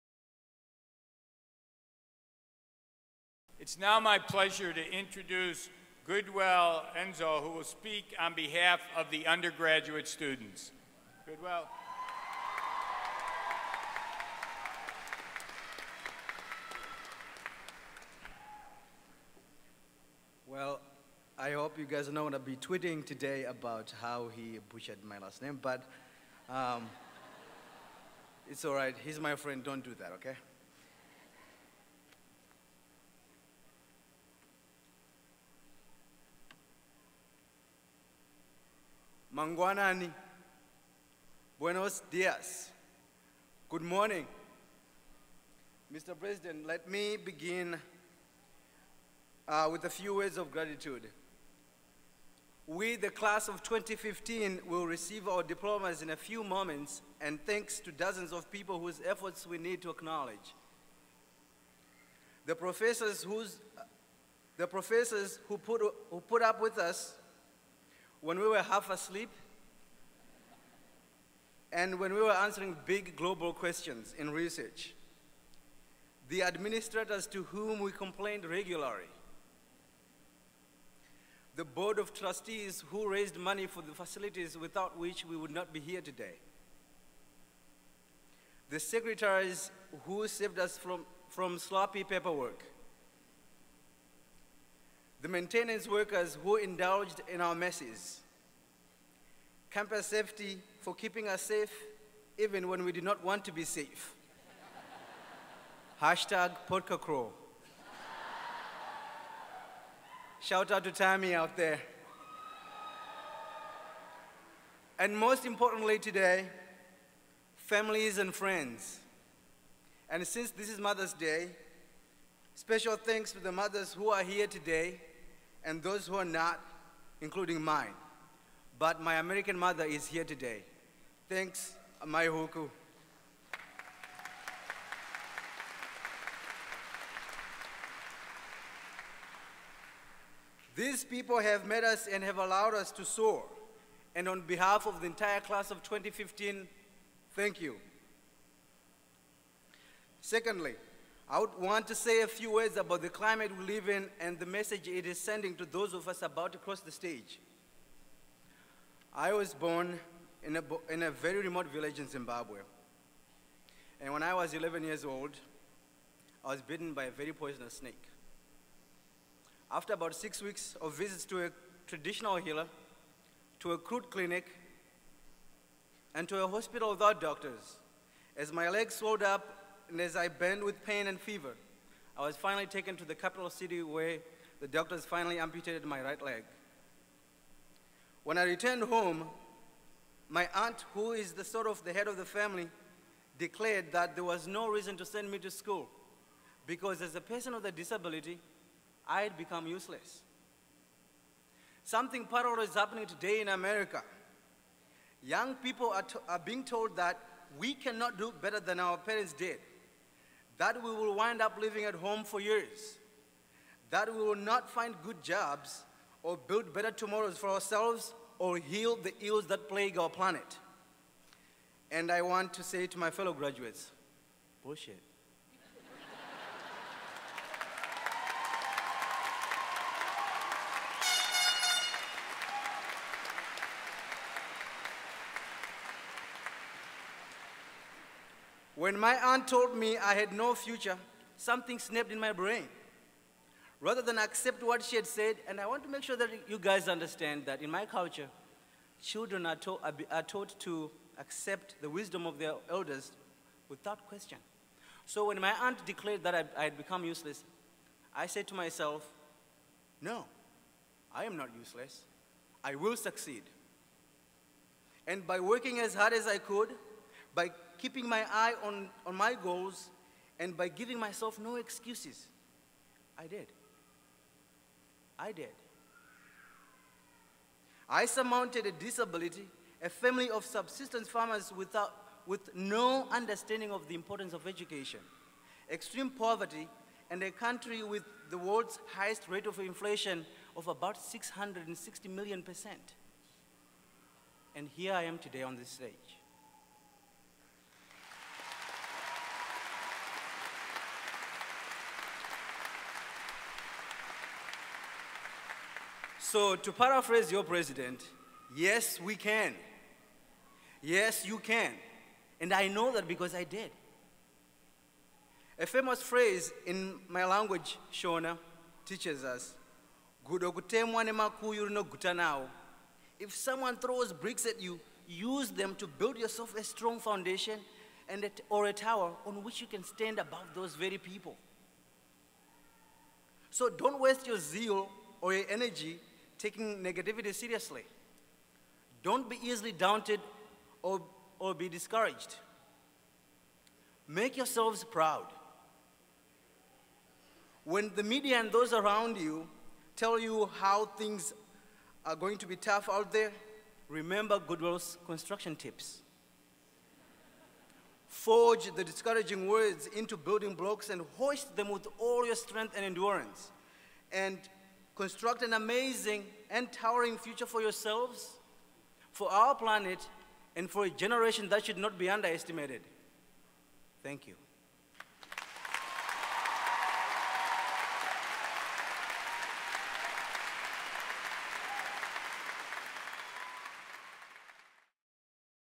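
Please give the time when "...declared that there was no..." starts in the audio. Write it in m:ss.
3:13.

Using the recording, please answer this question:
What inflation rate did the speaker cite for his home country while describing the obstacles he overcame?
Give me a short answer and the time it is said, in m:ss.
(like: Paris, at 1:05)
About 660 million percent, at 4:51.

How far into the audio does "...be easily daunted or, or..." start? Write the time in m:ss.
5:39.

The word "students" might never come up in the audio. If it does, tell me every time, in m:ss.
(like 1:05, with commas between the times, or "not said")
0:10.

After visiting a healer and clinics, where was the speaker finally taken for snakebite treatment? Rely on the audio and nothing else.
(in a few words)
The capital city.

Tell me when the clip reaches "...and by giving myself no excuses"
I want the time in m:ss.
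4:30.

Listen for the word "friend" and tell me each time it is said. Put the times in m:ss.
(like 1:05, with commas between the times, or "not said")
0:29, 1:58.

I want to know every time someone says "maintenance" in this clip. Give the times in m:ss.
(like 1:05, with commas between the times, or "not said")
1:35.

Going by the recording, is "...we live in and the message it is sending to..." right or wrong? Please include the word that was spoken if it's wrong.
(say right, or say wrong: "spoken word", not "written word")
right.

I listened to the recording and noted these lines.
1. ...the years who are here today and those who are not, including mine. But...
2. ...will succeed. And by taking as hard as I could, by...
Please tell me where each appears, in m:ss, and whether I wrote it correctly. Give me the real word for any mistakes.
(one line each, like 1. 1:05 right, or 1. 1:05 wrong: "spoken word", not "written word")
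1. 2:03 wrong: "mothers", not "years"
2. 4:22 wrong: "working", not "taking".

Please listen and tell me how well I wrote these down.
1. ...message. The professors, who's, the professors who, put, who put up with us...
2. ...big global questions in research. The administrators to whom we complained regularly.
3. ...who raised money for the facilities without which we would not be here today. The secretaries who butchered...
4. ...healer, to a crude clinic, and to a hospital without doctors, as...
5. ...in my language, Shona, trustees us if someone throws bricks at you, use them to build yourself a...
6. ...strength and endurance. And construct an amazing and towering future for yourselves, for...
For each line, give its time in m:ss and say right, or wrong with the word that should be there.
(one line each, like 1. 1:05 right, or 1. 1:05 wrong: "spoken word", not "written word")
1. 0:59 wrong: "acknowledge", not "message"
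2. 1:12 right
3. 1:22 wrong: "saved", not "butchered"
4. 2:52 right
5. 5:16 wrong: "teaches", not "trustees"
6. 6:02 right.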